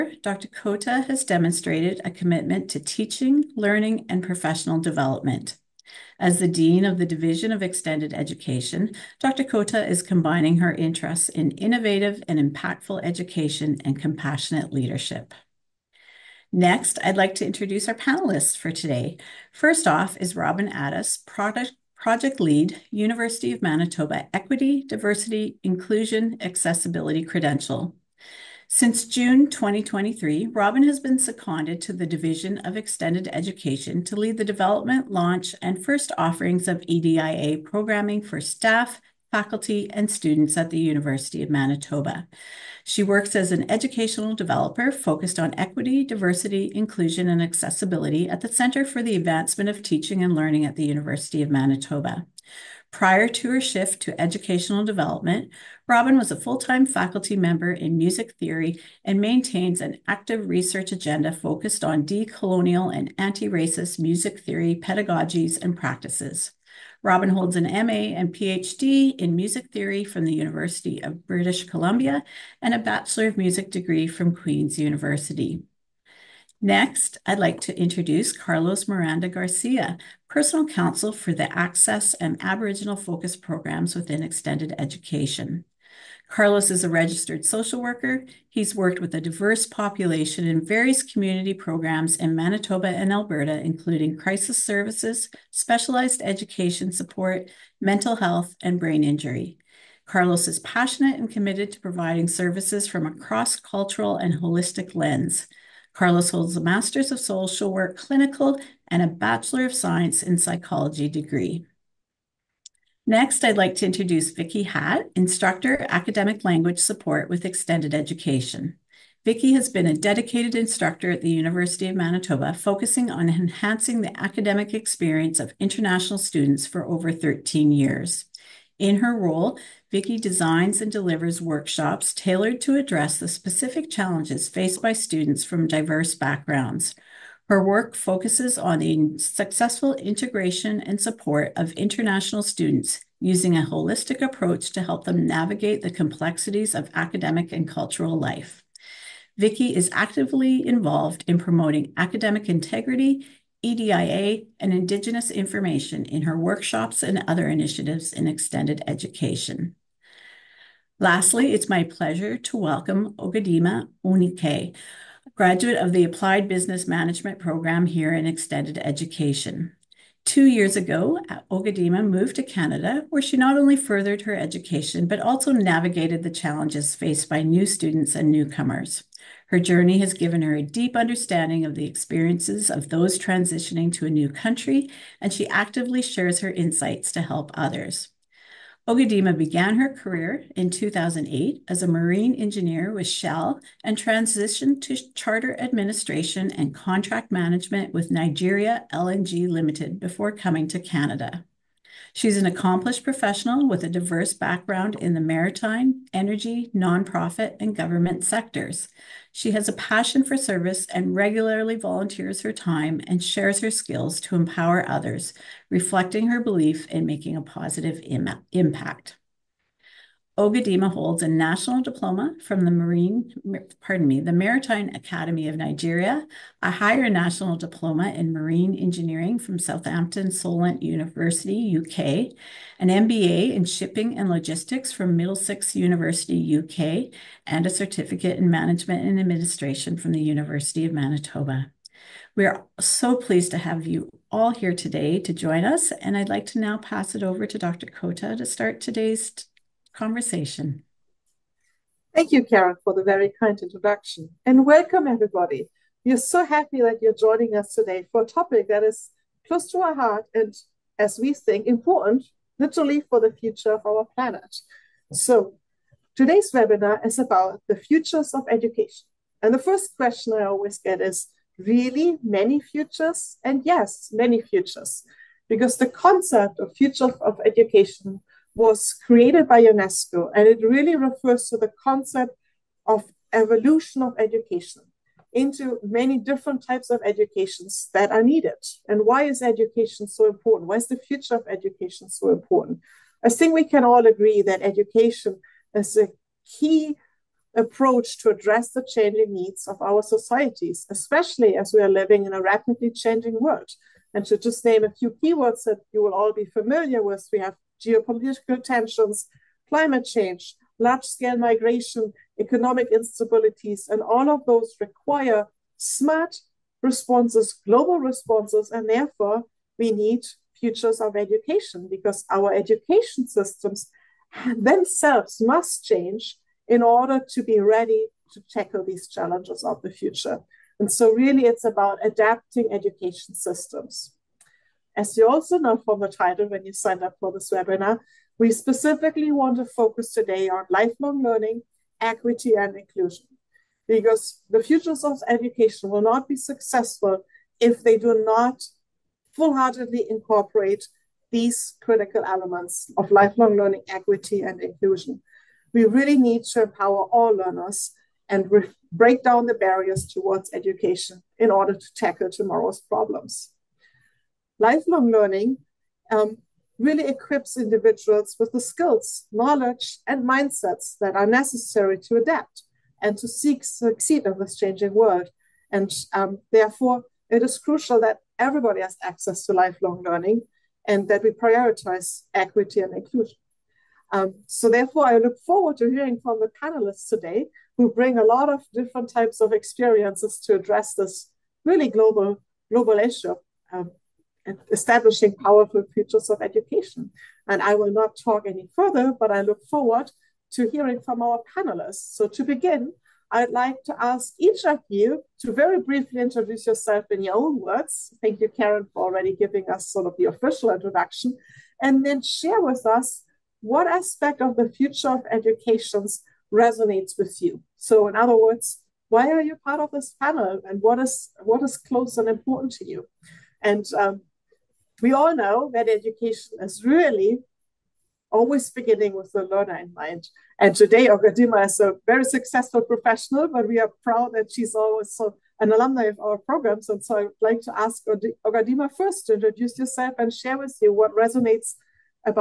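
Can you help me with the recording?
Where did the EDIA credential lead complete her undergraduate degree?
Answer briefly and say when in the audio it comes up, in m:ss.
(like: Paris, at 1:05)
Queen's University, at 1:14.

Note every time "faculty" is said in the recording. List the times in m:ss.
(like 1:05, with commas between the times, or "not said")
0:39, 0:56.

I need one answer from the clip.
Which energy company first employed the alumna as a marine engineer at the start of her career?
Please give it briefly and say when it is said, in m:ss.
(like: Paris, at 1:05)
Shell, at 3:13.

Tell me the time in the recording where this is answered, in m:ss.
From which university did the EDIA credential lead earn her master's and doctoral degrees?
1:10.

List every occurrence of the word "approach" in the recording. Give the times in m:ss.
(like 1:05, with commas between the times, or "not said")
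2:24, 4:57.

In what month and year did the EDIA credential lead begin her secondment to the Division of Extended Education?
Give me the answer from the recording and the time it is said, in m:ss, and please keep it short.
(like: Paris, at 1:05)
June 2023, at 0:29.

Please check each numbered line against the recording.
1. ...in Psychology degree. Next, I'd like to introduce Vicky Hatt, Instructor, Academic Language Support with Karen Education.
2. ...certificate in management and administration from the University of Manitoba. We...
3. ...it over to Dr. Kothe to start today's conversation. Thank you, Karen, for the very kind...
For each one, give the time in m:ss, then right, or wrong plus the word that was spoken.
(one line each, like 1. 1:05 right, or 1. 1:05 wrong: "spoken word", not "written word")
1. 1:50 wrong: "Extended", not "Karen"
2. 3:57 right
3. 4:07 right.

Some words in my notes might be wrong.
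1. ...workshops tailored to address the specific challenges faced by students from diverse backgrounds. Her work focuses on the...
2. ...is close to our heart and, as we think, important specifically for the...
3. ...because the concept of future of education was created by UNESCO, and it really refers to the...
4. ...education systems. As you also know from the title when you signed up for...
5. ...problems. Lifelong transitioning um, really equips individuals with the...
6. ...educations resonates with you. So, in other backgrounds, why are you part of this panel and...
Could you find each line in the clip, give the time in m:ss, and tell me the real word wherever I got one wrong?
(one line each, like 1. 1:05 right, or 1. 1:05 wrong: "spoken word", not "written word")
1. 2:11 right
2. 4:18 wrong: "literally", not "specifically"
3. 4:35 right
4. 5:32 right
5. 6:02 wrong: "learning", not "transitioning"
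6. 6:55 wrong: "words", not "backgrounds".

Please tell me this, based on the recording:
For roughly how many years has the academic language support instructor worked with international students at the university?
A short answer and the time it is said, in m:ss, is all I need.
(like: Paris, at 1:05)
13, at 2:07.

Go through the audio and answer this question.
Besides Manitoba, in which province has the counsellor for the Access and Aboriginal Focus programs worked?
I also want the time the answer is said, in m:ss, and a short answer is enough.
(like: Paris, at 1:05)
Alberta, at 1:33.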